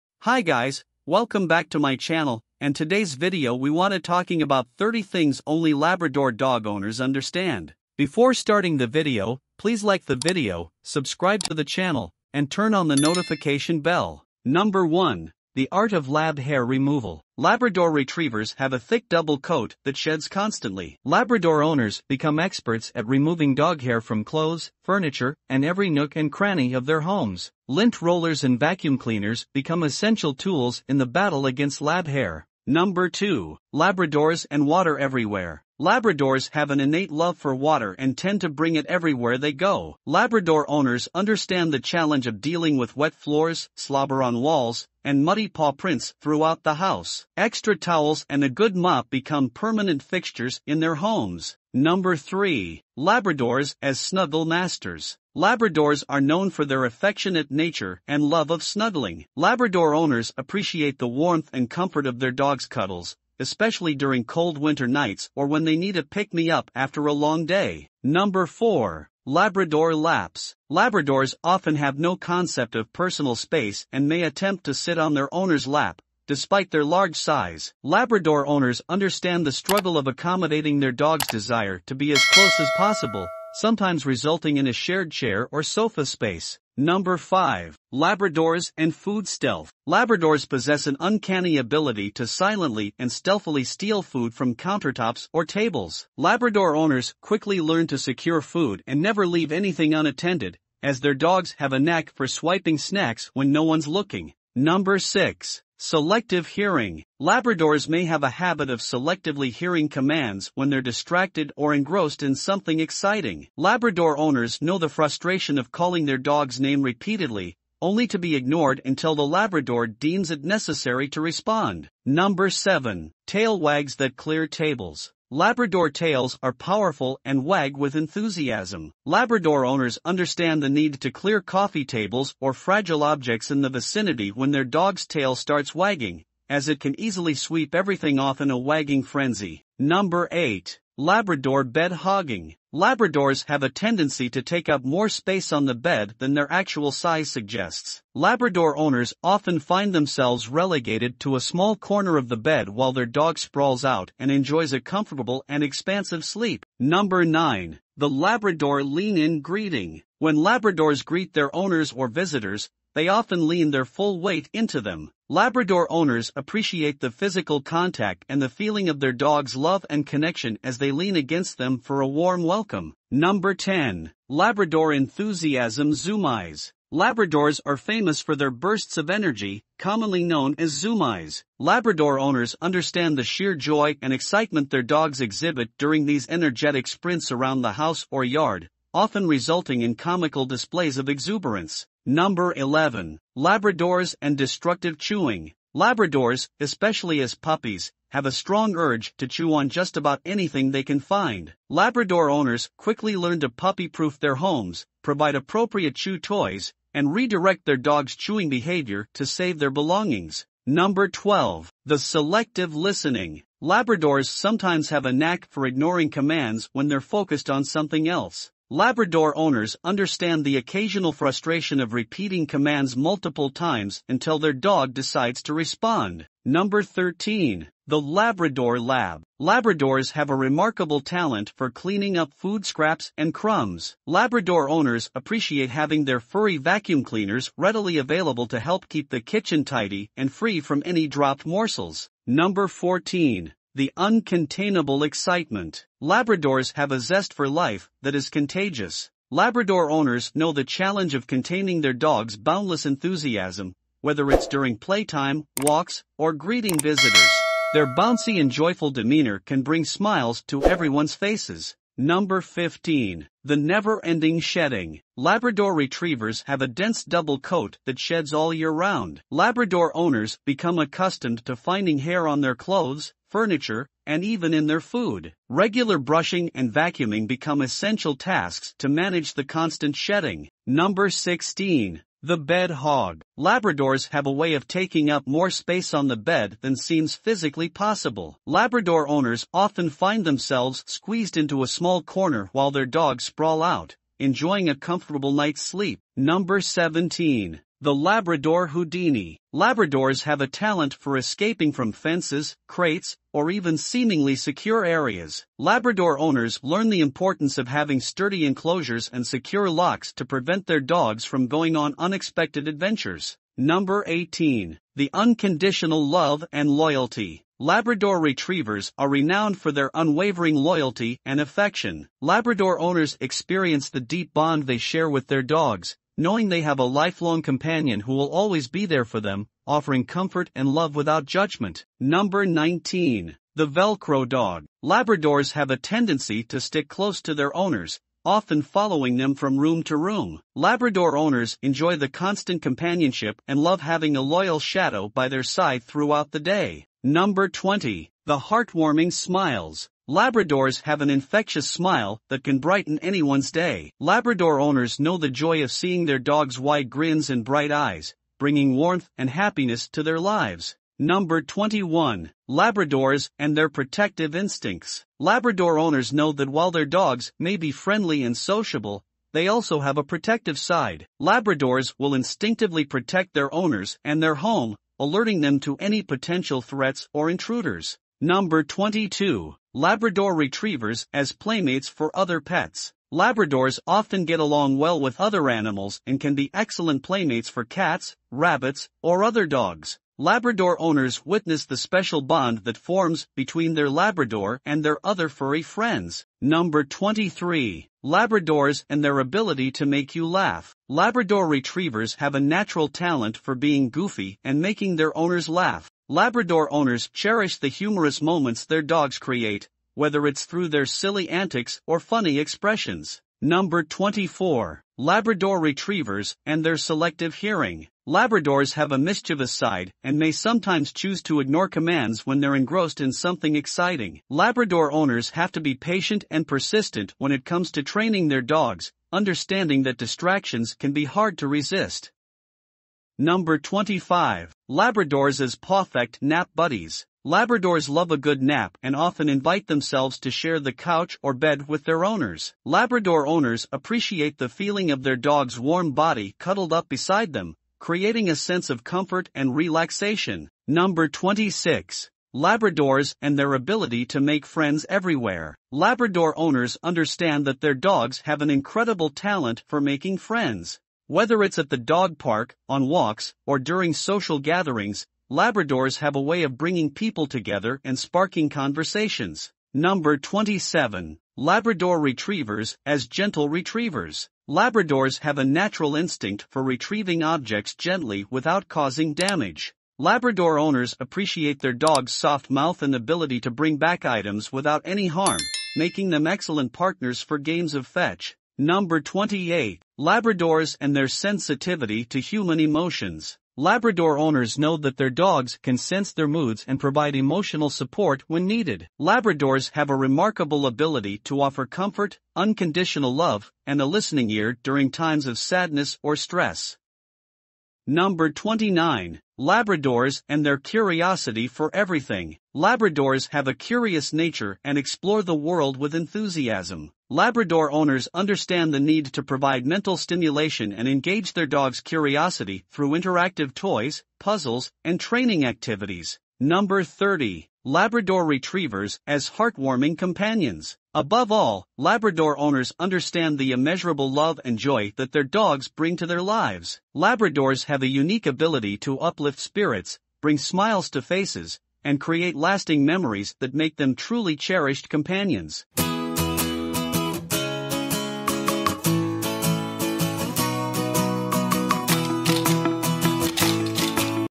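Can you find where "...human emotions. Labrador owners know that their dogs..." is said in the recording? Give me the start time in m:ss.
8:12.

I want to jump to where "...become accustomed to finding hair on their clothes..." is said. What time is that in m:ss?
4:30.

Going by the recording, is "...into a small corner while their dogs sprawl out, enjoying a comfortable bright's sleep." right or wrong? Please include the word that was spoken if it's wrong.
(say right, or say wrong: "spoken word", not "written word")
wrong: "night", not "bright".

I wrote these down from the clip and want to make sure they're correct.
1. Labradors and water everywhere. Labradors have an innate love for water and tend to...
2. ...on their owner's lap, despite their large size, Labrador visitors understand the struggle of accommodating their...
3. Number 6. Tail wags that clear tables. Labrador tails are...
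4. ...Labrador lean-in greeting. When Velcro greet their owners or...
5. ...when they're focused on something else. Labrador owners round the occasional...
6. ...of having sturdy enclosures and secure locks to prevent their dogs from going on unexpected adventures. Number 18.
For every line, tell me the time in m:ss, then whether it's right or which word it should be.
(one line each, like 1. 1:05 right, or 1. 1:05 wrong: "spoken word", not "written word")
1. 0:33 right
2. 1:14 wrong: "owners", not "visitors"
3. 2:02 wrong: "7", not "6"
4. 2:38 wrong: "Labradors", not "Velcro"
5. 3:36 wrong: "understand", not "round"
6. 5:07 right.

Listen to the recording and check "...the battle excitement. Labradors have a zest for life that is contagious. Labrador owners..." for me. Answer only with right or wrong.
wrong.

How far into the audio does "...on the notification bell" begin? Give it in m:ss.
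0:12.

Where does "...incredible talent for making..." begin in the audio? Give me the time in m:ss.
7:38.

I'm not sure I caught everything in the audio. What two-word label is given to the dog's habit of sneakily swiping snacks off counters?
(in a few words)
Food Stealth.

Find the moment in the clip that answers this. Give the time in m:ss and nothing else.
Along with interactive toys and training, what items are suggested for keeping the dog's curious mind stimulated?
8:44.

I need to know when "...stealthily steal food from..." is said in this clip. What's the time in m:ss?
1:33.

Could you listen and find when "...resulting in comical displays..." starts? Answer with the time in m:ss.
3:09.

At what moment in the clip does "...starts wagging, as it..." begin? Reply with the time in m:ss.
2:15.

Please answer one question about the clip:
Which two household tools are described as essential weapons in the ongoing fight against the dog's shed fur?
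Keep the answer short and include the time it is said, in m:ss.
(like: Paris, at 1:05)
Lint rollers and vacuum cleaners, at 0:27.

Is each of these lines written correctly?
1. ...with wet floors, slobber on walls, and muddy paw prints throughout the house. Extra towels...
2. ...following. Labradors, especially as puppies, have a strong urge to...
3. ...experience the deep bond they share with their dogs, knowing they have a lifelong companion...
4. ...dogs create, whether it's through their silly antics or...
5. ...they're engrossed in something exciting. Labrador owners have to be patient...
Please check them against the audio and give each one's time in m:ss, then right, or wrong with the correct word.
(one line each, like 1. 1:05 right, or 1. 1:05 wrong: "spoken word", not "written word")
1. 0:42 right
2. 3:14 wrong: "chewing", not "following"
3. 5:23 right
4. 6:48 right
5. 7:02 right.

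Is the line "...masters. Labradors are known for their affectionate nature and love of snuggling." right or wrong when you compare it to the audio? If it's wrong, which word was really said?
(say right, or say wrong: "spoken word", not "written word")
right.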